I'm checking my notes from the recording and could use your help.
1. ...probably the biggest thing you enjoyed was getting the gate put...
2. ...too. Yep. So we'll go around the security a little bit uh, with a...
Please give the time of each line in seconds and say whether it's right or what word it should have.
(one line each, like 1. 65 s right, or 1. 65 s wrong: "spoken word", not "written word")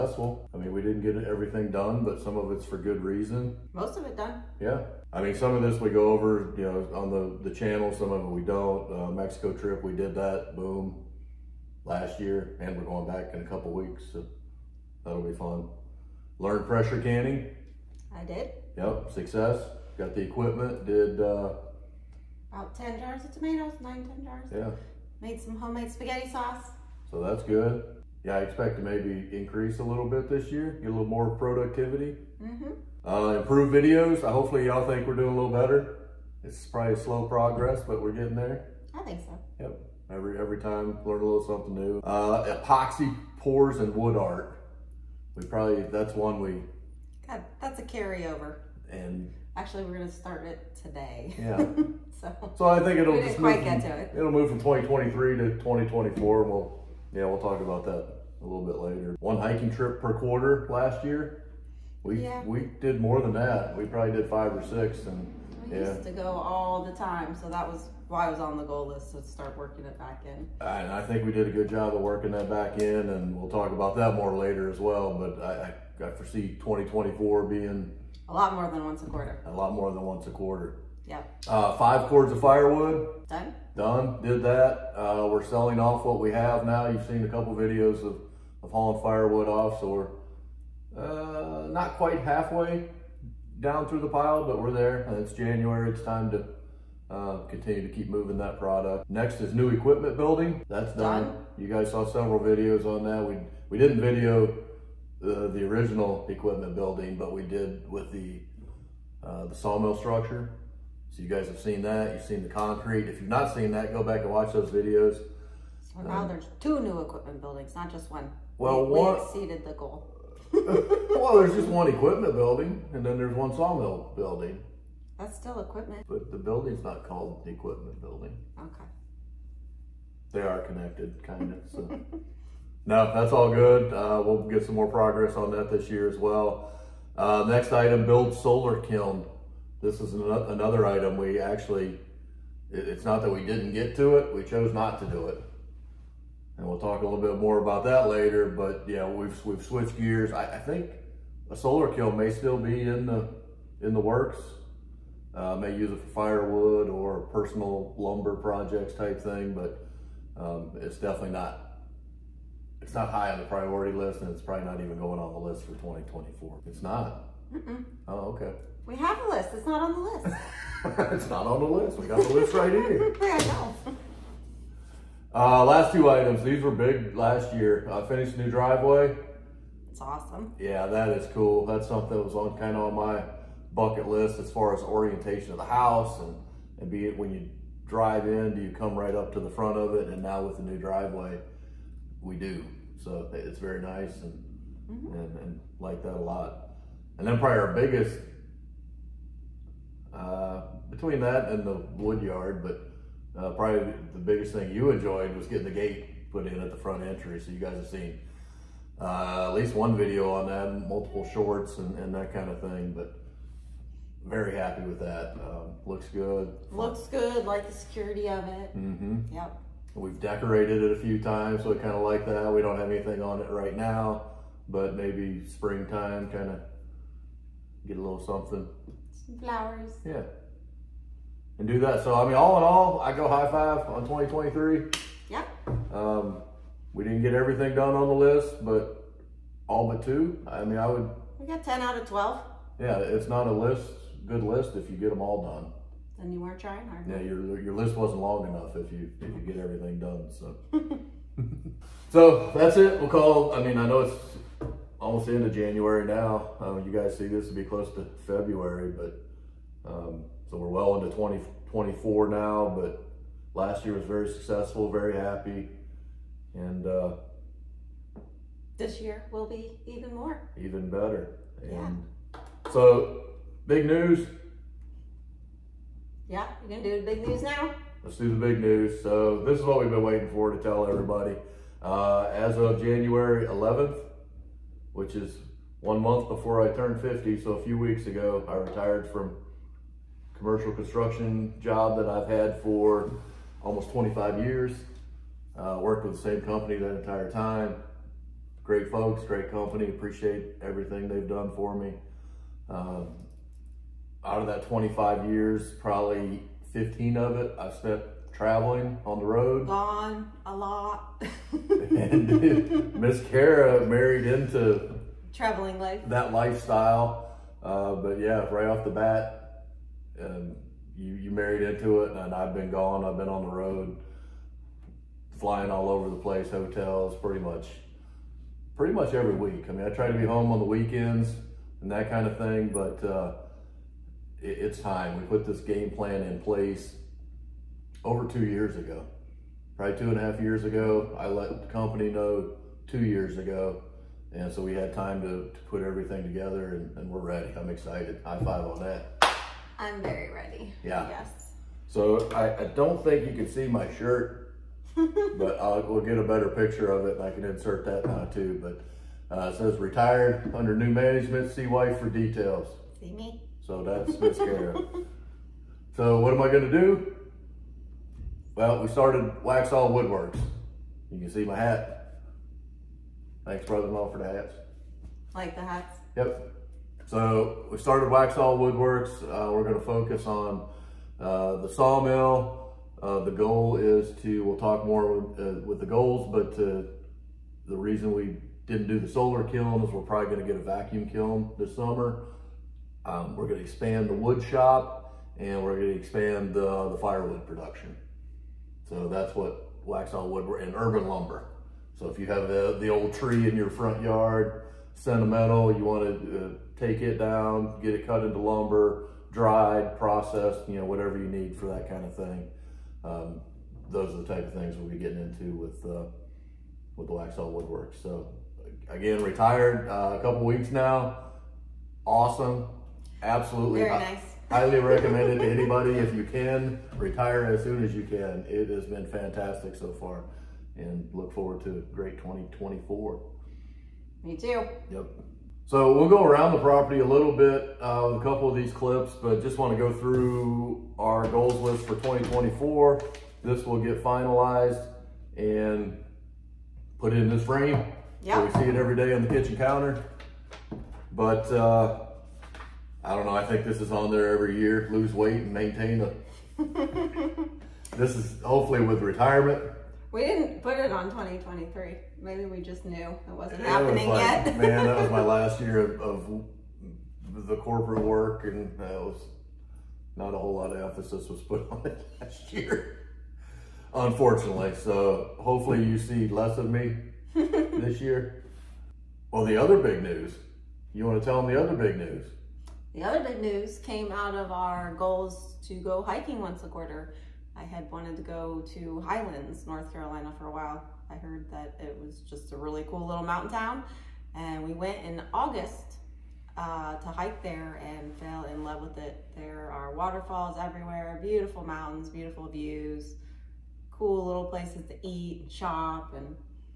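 1. 203 s right
2. 434 s wrong: "property", not "security".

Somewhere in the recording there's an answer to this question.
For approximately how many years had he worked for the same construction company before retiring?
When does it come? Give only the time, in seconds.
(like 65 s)
293 s.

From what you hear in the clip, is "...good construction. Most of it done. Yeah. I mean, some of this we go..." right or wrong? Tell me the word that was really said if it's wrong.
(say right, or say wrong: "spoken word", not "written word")
wrong: "reason", not "construction".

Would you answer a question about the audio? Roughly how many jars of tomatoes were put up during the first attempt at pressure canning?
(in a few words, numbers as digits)
10.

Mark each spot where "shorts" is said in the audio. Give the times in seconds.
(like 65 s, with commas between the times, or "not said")
211 s.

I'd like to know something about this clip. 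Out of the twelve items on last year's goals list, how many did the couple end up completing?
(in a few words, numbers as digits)
10.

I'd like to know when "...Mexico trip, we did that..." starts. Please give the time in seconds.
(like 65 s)
9 s.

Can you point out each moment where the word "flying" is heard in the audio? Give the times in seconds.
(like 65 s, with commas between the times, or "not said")
325 s.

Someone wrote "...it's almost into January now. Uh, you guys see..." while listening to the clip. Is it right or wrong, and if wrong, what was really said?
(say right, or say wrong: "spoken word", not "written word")
right.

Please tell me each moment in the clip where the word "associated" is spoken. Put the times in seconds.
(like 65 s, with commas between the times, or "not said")
not said.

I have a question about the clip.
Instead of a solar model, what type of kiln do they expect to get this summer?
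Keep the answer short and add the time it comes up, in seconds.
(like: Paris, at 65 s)
vacuum kiln, at 390 s.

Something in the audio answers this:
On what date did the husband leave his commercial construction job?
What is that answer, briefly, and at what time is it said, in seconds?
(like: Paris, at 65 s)
January 11th, at 282 s.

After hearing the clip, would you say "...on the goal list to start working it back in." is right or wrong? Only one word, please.
right.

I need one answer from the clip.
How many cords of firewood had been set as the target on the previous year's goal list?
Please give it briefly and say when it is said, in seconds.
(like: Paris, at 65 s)
5, at 81 s.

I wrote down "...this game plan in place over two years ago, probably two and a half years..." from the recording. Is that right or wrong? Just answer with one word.
right.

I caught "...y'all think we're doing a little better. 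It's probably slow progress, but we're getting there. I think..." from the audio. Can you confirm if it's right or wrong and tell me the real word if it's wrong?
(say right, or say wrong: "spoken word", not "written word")
right.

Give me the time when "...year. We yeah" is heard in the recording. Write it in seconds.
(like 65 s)
61 s.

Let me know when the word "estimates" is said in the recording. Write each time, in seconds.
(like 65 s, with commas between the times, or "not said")
not said.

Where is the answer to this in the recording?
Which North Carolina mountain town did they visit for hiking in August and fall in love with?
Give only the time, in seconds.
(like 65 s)
488 s.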